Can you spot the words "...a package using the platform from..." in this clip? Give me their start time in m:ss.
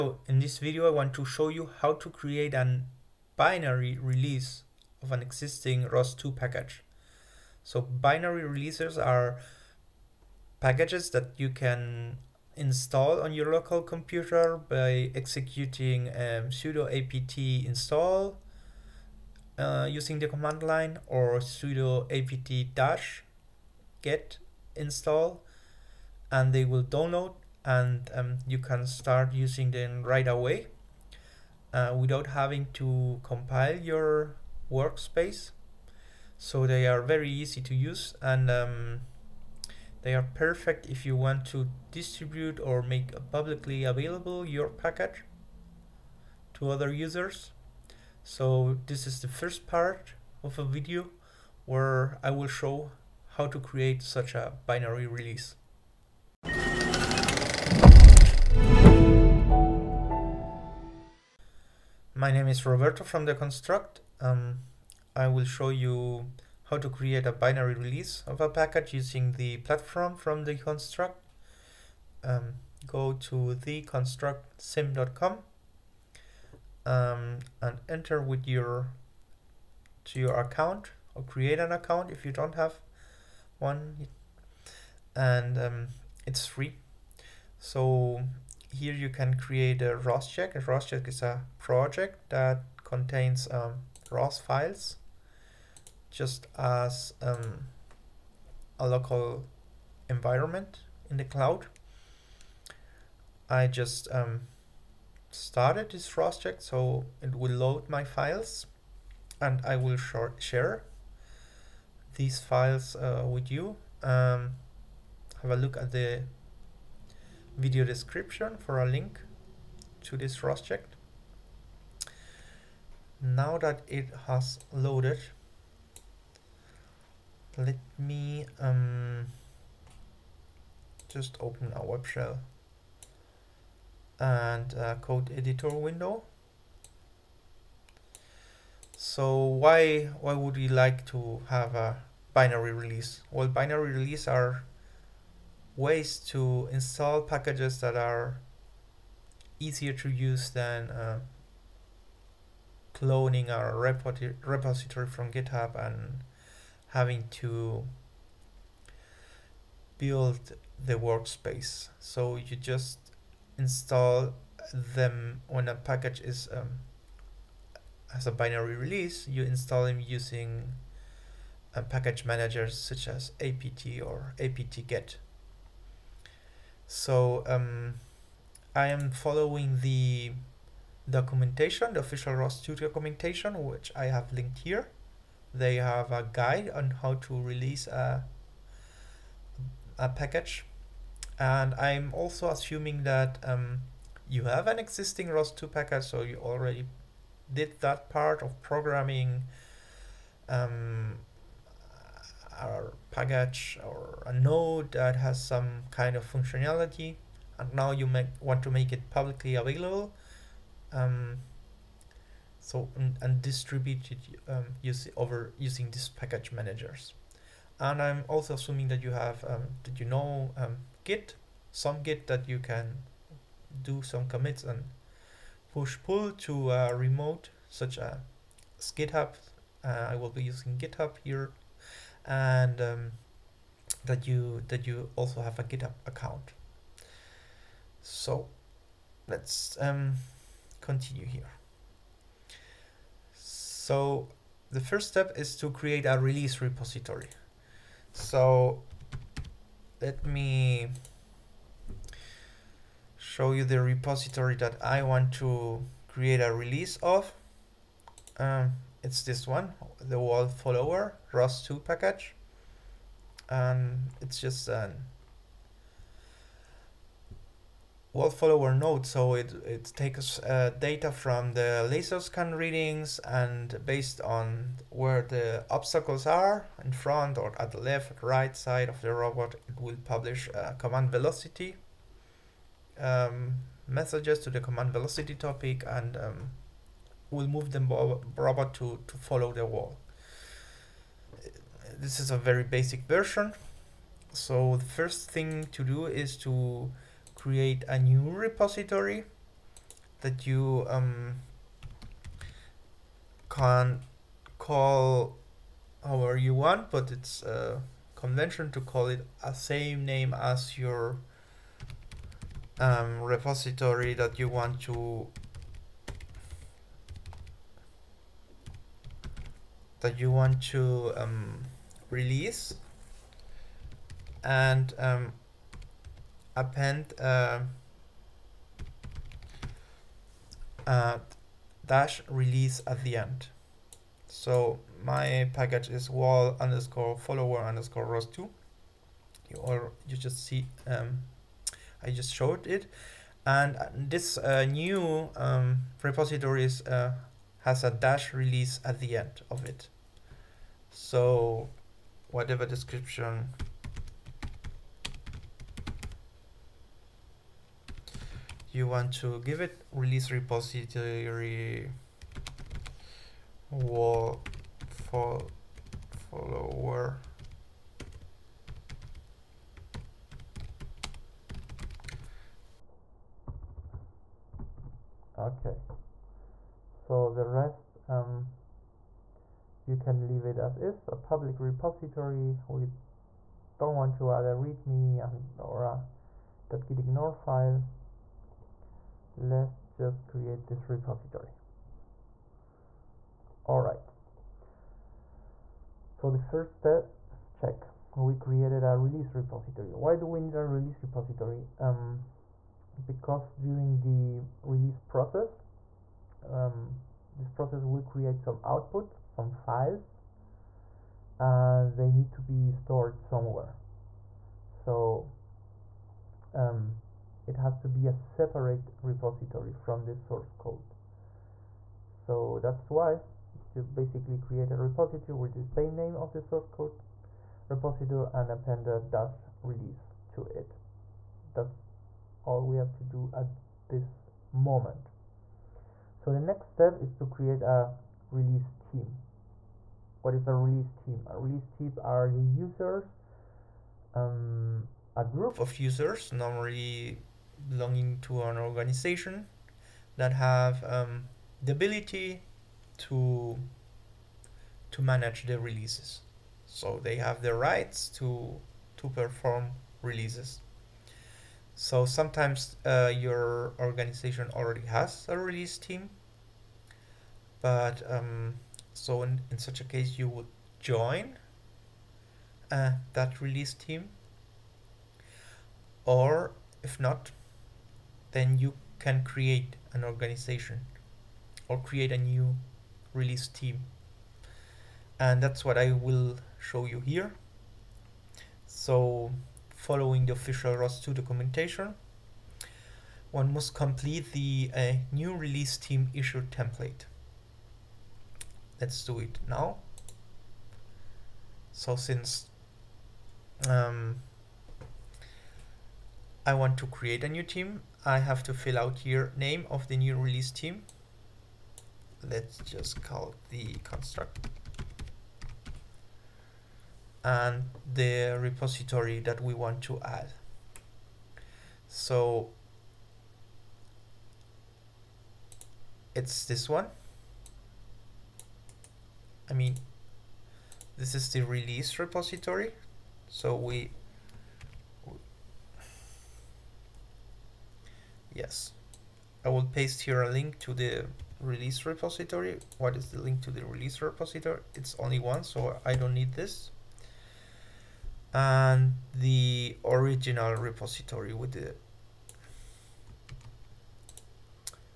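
1:08.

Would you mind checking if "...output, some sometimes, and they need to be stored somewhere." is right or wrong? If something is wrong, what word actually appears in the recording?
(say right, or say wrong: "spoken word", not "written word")
wrong: "files", not "sometimes".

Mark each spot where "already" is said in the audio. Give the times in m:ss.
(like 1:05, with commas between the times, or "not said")
3:16, 7:44.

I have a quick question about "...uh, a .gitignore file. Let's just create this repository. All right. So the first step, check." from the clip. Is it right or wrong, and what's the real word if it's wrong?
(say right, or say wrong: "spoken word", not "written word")
right.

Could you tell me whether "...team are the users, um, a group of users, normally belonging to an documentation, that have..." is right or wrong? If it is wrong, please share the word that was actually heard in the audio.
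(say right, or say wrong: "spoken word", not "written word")
wrong: "organization", not "documentation".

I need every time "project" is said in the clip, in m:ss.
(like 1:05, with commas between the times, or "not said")
1:31, 2:00.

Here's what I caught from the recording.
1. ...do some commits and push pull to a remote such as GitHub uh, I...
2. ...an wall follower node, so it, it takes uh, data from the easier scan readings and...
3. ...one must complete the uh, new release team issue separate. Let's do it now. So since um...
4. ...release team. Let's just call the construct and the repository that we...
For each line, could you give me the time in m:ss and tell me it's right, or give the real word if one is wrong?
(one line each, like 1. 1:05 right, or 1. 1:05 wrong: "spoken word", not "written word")
1. 3:43 right
2. 4:24 wrong: "laser", not "easier"
3. 8:13 wrong: "template", not "separate"
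4. 8:30 right.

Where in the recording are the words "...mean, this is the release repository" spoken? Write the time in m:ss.
8:49.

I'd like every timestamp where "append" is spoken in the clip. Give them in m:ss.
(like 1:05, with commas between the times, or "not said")
5:26, 7:08.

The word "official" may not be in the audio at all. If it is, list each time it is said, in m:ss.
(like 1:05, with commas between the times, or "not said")
3:02, 8:10.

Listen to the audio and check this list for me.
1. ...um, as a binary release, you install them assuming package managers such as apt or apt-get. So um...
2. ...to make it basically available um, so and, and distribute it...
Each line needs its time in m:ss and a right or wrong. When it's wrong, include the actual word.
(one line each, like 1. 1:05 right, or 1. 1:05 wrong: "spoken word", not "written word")
1. 2:46 wrong: "using", not "assuming"
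2. 3:28 wrong: "publicly", not "basically".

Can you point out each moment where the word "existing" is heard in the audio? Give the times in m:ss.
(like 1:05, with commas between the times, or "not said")
0:05, 3:14.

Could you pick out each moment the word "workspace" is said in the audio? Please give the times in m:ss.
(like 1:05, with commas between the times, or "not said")
0:34, 2:40.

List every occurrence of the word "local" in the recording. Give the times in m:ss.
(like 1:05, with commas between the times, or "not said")
0:13, 1:38.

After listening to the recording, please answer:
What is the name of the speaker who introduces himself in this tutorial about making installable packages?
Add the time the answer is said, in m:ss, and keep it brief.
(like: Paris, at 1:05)
Roberto, at 1:02.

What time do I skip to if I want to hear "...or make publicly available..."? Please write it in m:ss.
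0:42.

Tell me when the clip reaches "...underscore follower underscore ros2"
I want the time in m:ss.
5:36.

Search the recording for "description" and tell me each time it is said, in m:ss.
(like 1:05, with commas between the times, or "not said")
1:57, 5:52.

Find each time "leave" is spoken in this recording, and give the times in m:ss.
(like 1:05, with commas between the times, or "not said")
6:20.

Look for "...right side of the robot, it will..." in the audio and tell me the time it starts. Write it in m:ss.
4:38.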